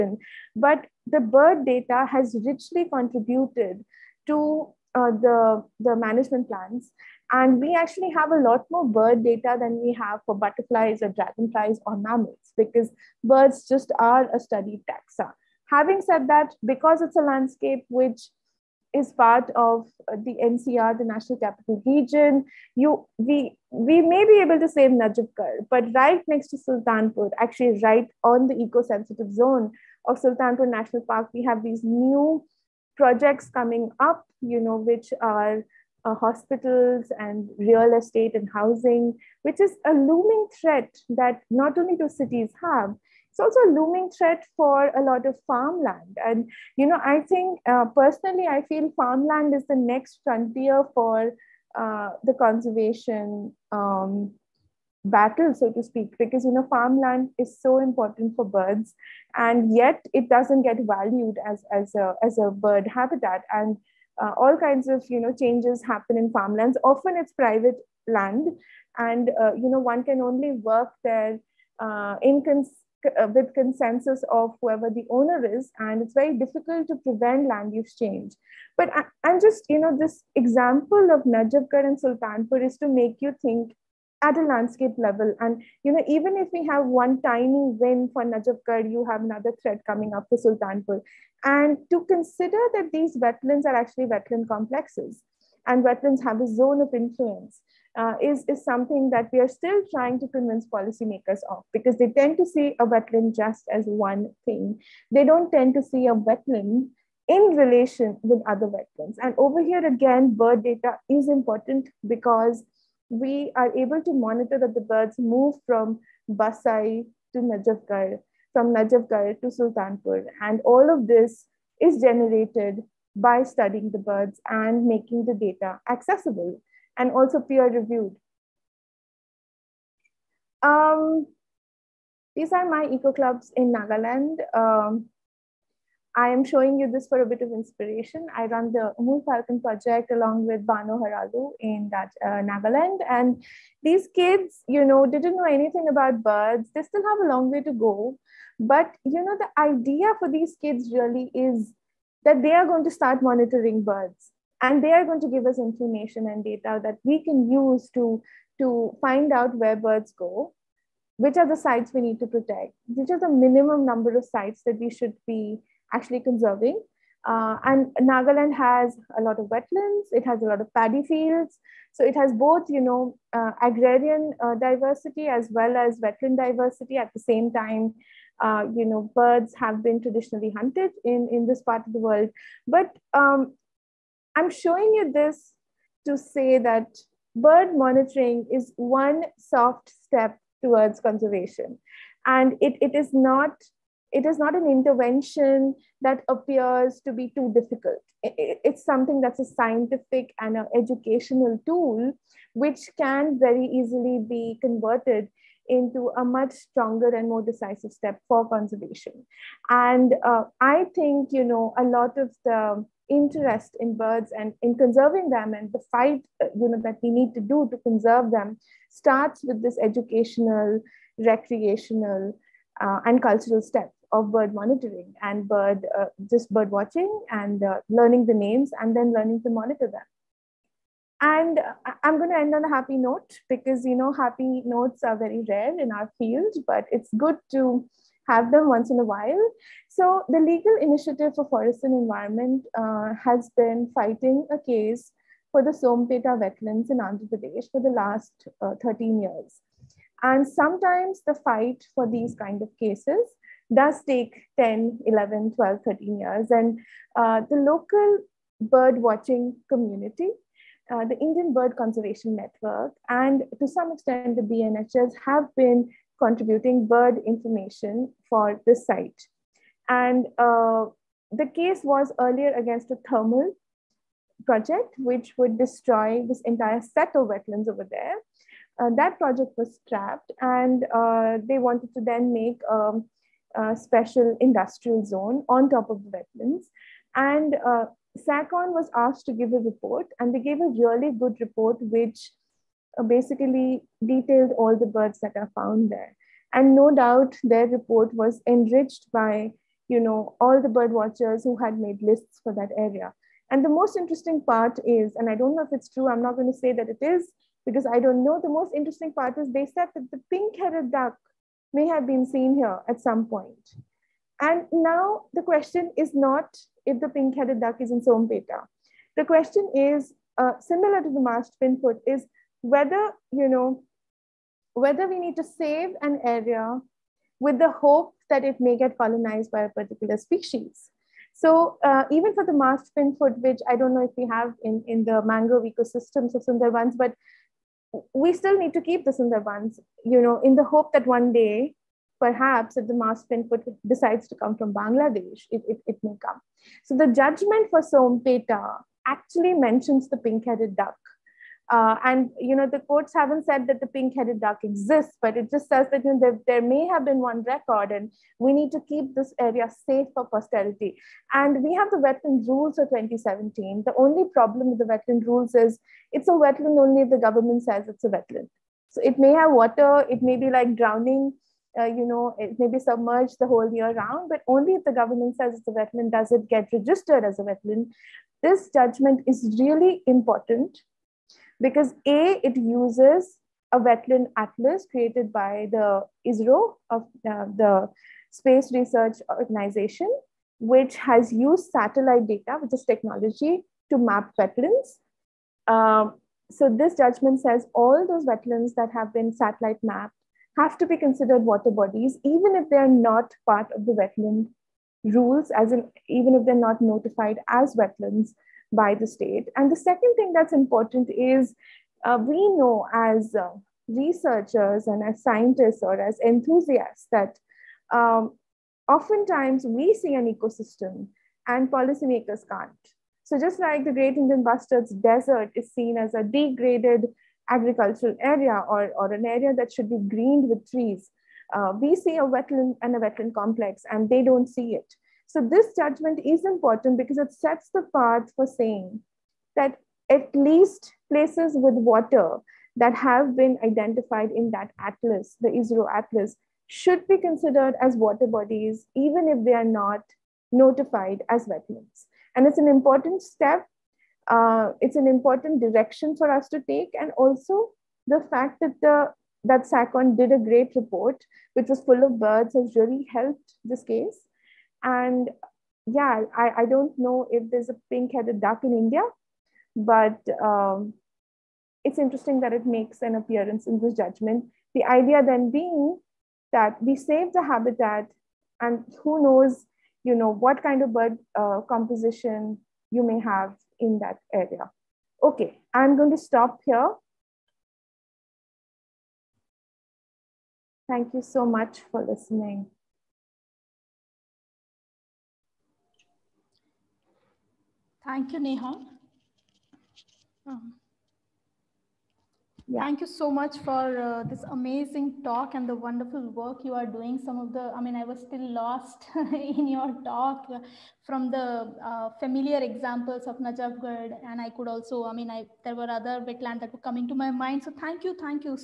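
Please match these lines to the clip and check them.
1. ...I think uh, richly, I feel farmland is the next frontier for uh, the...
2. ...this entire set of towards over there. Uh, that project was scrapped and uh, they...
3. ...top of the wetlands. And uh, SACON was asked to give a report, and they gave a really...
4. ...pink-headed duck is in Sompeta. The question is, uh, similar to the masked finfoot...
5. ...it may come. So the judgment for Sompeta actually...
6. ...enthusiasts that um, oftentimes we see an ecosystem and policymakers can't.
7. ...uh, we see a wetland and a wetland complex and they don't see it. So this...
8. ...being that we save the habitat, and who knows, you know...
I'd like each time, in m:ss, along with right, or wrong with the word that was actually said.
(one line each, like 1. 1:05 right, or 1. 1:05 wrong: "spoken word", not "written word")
1. 0:47 wrong: "personally", not "richly"
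2. 4:36 wrong: "wetlands", not "towards"
3. 4:45 right
4. 5:17 right
5. 5:45 right
6. 6:56 right
7. 7:11 right
8. 7:55 right.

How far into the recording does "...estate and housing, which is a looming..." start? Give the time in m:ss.
0:37.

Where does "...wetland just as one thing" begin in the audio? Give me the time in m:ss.
1:42.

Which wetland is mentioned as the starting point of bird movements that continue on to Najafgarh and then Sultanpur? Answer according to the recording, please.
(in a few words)
Basai.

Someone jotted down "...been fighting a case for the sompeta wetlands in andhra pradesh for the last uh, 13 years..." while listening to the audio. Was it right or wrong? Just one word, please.
right.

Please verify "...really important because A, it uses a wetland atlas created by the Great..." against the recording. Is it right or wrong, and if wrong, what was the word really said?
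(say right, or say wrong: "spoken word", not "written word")
wrong: "ISRO", not "Great".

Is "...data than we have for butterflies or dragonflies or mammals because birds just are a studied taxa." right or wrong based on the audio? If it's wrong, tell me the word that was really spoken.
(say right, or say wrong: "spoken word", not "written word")
right.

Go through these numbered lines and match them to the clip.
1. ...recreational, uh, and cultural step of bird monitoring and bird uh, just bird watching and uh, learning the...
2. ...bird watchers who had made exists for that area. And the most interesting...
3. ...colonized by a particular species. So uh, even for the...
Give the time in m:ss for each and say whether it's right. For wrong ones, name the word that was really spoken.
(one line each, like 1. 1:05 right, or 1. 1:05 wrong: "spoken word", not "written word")
1. 3:41 right
2. 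5:00 wrong: "lists", not "exists"
3. 5:28 right.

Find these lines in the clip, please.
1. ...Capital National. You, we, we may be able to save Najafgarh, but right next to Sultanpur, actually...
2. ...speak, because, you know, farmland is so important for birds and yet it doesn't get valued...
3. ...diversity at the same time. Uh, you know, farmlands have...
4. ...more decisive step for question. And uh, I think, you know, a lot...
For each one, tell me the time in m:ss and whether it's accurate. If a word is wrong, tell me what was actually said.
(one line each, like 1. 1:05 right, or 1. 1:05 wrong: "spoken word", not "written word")
1. 0:21 wrong: "Region", not "National"
2. 0:55 right
3. 2:56 wrong: "birds", not "farmlands"
4. 3:27 wrong: "conservation", not "question".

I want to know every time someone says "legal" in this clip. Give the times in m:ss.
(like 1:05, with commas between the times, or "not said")
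4:00.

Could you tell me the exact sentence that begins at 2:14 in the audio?
Um, I am showing you this for a bit of inspiration.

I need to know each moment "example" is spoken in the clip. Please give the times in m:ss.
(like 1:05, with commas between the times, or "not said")
1:20, 8:32.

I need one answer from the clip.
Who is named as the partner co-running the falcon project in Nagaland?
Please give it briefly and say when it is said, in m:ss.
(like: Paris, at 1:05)
Bano Haralu, at 2:20.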